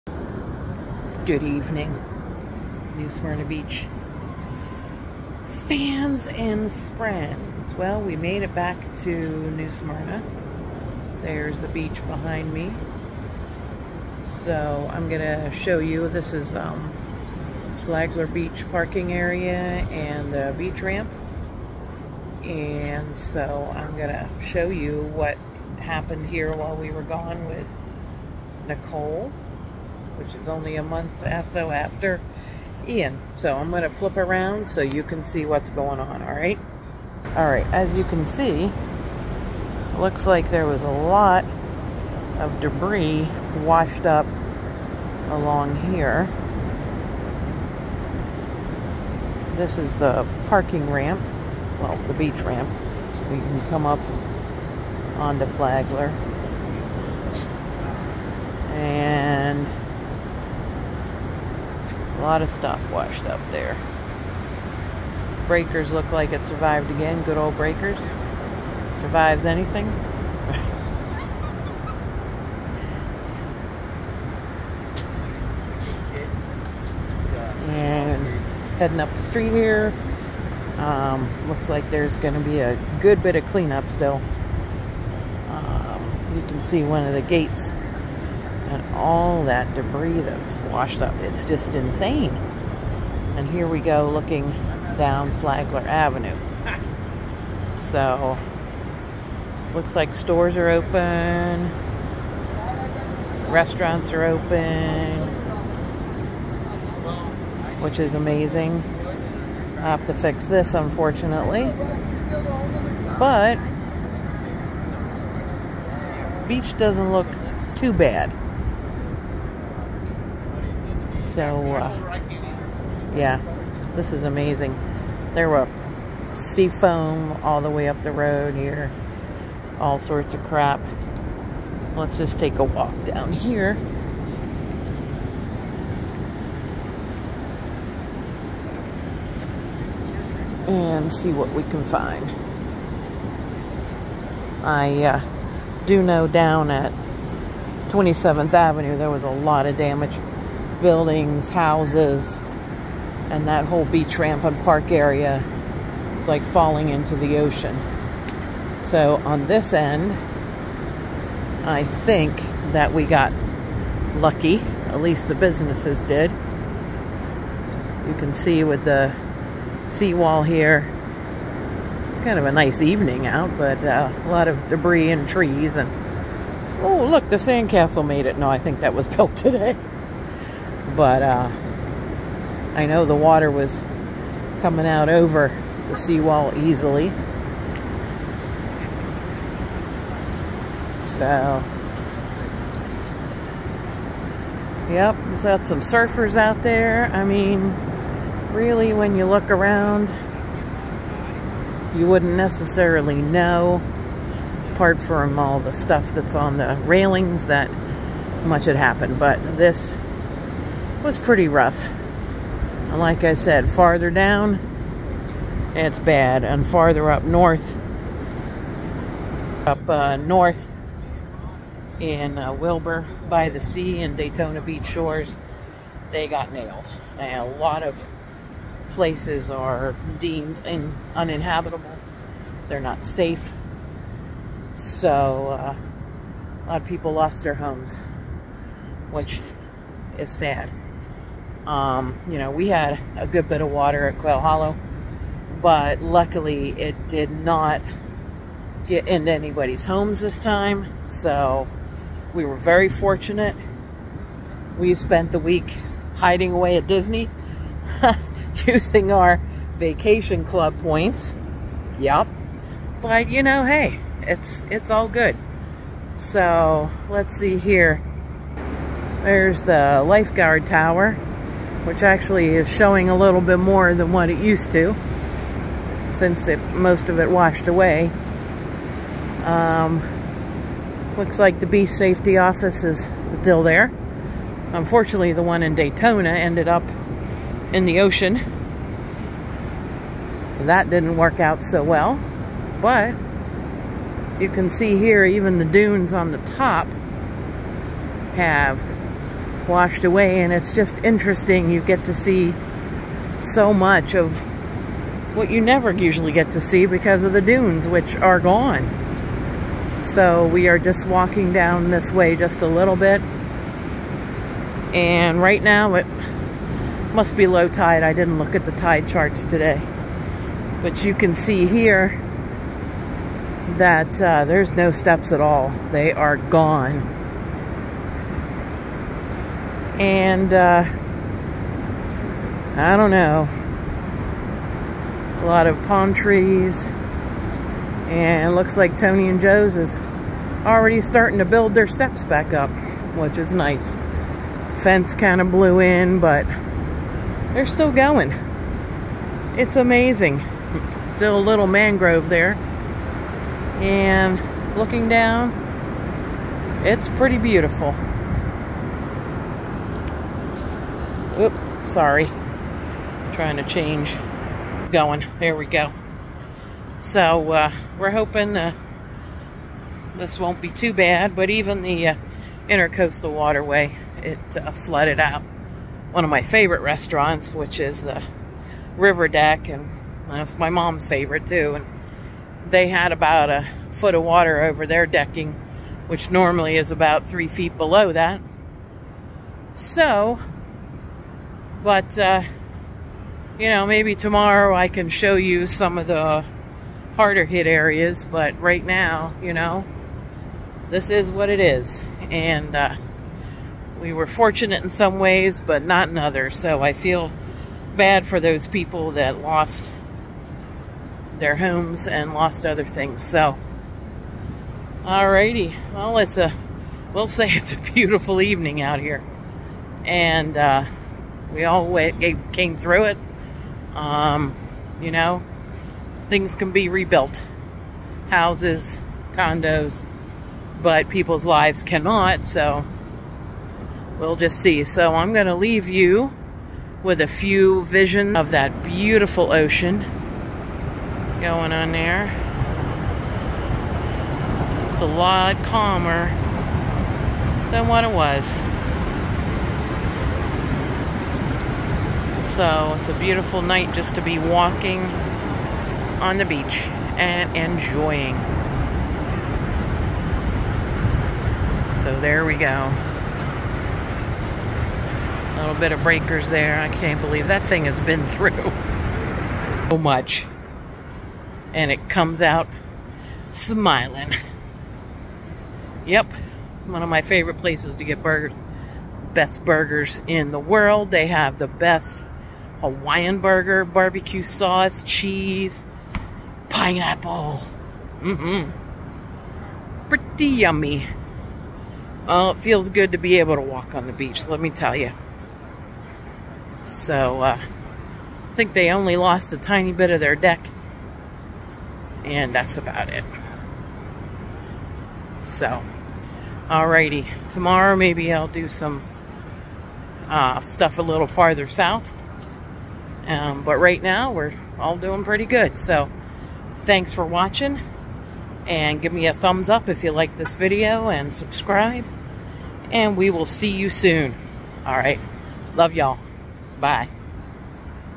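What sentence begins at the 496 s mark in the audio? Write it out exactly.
So, uh, I think they only lost a tiny bit of their deck.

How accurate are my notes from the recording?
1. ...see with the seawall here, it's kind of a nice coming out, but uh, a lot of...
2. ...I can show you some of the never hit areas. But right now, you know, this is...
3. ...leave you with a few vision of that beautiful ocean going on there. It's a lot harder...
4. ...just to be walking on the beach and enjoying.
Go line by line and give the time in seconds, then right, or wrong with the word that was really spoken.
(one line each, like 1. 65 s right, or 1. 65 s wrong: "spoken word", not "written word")
1. 168 s wrong: "evening", not "coming"
2. 394 s wrong: "harder", not "never"
3. 435 s wrong: "calmer", not "harder"
4. 453 s right.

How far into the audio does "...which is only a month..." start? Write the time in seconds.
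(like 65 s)
30 s.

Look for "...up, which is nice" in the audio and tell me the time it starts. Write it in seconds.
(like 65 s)
342 s.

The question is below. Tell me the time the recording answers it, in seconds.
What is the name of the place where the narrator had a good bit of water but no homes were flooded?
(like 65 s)
244 s.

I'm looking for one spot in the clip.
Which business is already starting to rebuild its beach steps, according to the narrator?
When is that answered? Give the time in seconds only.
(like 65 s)
338 s.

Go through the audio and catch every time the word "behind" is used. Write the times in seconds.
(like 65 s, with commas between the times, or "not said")
12 s.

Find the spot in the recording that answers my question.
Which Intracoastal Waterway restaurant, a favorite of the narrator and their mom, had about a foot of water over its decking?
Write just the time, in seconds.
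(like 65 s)
378 s.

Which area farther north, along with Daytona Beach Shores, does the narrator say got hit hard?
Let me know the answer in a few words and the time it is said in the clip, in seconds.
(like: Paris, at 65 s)
Wilbur by the Sea, at 222 s.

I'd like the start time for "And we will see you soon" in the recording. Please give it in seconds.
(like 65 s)
522 s.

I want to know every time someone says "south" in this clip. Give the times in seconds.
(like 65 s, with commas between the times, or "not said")
511 s.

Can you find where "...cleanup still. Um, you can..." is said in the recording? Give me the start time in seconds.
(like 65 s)
83 s.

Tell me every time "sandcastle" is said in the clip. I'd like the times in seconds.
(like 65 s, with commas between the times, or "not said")
177 s.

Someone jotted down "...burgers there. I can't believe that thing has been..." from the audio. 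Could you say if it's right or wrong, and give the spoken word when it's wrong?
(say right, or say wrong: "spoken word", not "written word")
wrong: "breakers", not "burgers".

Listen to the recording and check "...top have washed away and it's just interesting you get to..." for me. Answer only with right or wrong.
right.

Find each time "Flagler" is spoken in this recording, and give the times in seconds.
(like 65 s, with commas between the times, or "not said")
17 s, 55 s, 95 s.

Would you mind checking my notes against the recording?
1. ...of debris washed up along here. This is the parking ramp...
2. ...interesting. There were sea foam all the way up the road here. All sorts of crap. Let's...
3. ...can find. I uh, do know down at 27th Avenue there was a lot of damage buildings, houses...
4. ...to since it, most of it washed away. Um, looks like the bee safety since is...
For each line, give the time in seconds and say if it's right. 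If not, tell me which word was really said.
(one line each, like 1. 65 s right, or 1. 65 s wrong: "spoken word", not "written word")
1. 42 s right
2. 124 s wrong: "amazing", not "interesting"
3. 141 s right
4. 274 s wrong: "office", not "since".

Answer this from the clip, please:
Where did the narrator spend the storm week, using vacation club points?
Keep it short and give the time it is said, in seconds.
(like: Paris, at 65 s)
Disney, at 256 s.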